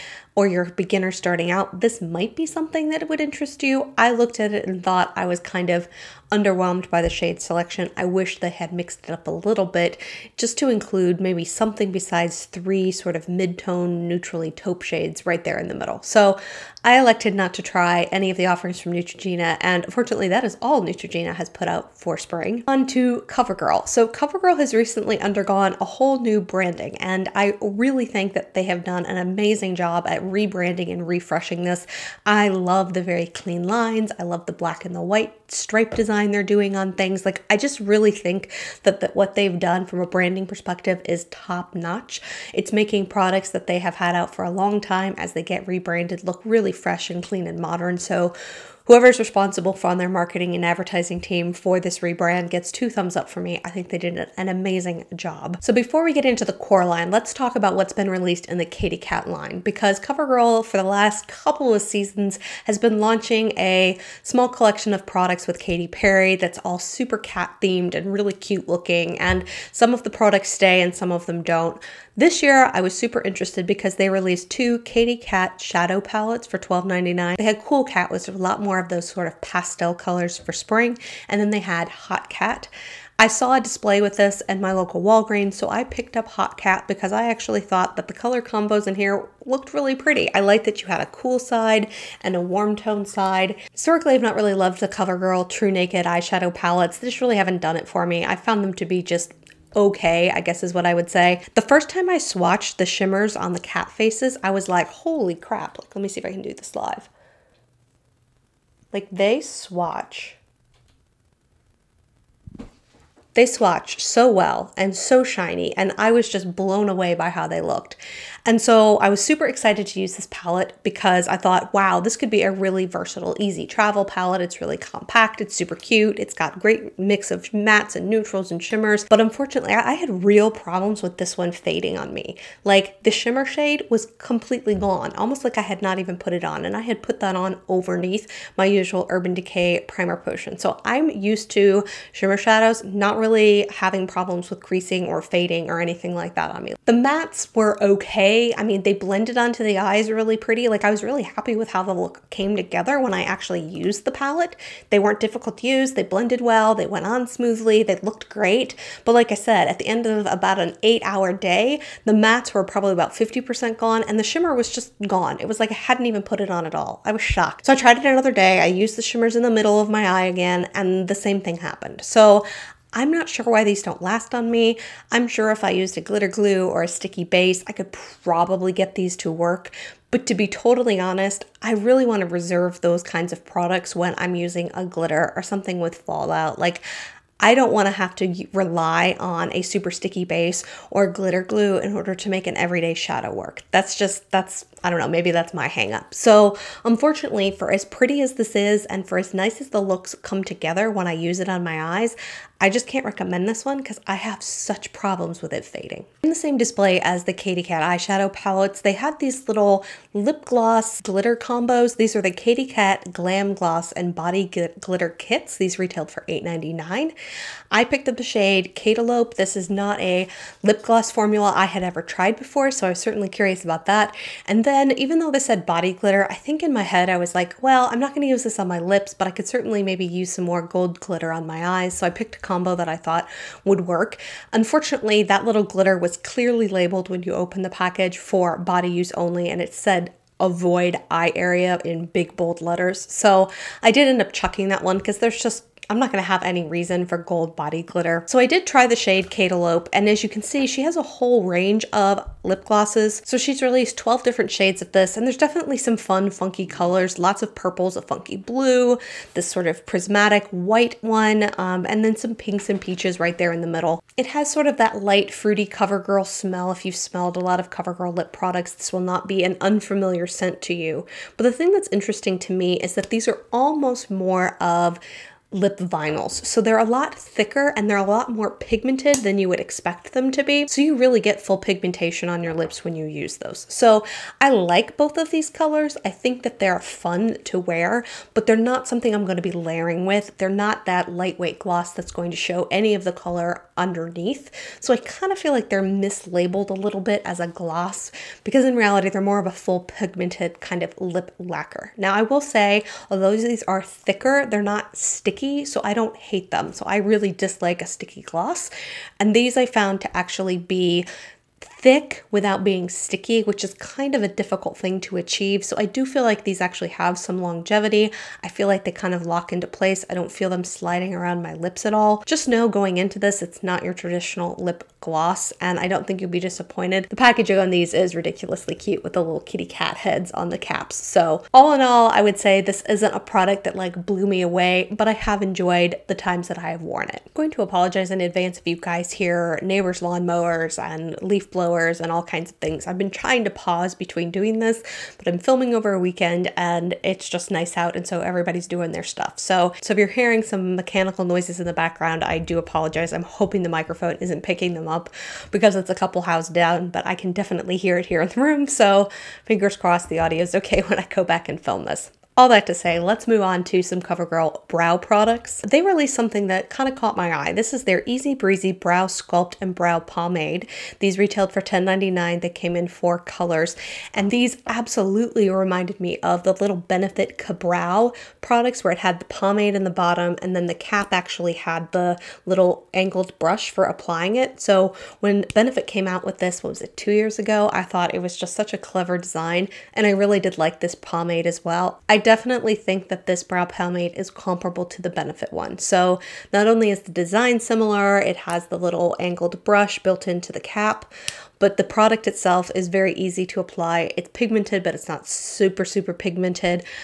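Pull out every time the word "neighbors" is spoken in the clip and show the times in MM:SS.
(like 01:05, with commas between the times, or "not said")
05:39.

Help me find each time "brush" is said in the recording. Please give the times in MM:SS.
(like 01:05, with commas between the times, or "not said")
06:23, 06:39.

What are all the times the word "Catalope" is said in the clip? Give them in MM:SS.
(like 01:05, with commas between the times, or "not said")
03:38, 04:09.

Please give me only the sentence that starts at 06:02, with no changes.
All that to say, let's move on to some CoverGirl brow products.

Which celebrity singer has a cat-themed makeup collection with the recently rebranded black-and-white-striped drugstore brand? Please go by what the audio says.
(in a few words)
Katy Perry.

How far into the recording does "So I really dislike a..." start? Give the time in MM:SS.
05:06.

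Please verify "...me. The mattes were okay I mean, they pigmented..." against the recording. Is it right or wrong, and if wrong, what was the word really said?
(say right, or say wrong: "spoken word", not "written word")
wrong: "blended", not "pigmented".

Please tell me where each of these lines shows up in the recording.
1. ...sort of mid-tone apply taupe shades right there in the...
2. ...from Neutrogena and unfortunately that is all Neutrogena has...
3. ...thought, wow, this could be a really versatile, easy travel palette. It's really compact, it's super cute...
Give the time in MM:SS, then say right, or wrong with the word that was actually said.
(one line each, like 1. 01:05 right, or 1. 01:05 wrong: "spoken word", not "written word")
1. 00:12 wrong: "neutrally", not "apply"
2. 00:18 right
3. 02:01 right.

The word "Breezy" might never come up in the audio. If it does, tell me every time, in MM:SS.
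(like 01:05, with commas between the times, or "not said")
06:08.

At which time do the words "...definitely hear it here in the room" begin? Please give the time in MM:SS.
05:57.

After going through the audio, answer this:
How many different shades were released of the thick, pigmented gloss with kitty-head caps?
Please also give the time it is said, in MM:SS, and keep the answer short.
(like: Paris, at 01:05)
12, at 04:13.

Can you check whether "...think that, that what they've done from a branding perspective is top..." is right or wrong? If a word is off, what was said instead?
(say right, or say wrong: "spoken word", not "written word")
right.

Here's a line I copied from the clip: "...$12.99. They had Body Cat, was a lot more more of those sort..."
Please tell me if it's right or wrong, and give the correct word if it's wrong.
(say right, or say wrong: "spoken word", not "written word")
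wrong: "Cool", not "Body".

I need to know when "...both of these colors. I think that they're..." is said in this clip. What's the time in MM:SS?
04:44.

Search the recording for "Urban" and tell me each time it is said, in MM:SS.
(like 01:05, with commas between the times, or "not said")
02:19.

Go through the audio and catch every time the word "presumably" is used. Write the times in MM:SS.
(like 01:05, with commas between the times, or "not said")
not said.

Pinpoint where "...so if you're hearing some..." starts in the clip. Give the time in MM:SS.
05:49.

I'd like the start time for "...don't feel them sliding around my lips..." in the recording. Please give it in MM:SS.
05:20.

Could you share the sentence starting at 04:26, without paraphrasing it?
If you've smelled a lot of CoverGirl lip products, this will not be an unfamiliar scent to you.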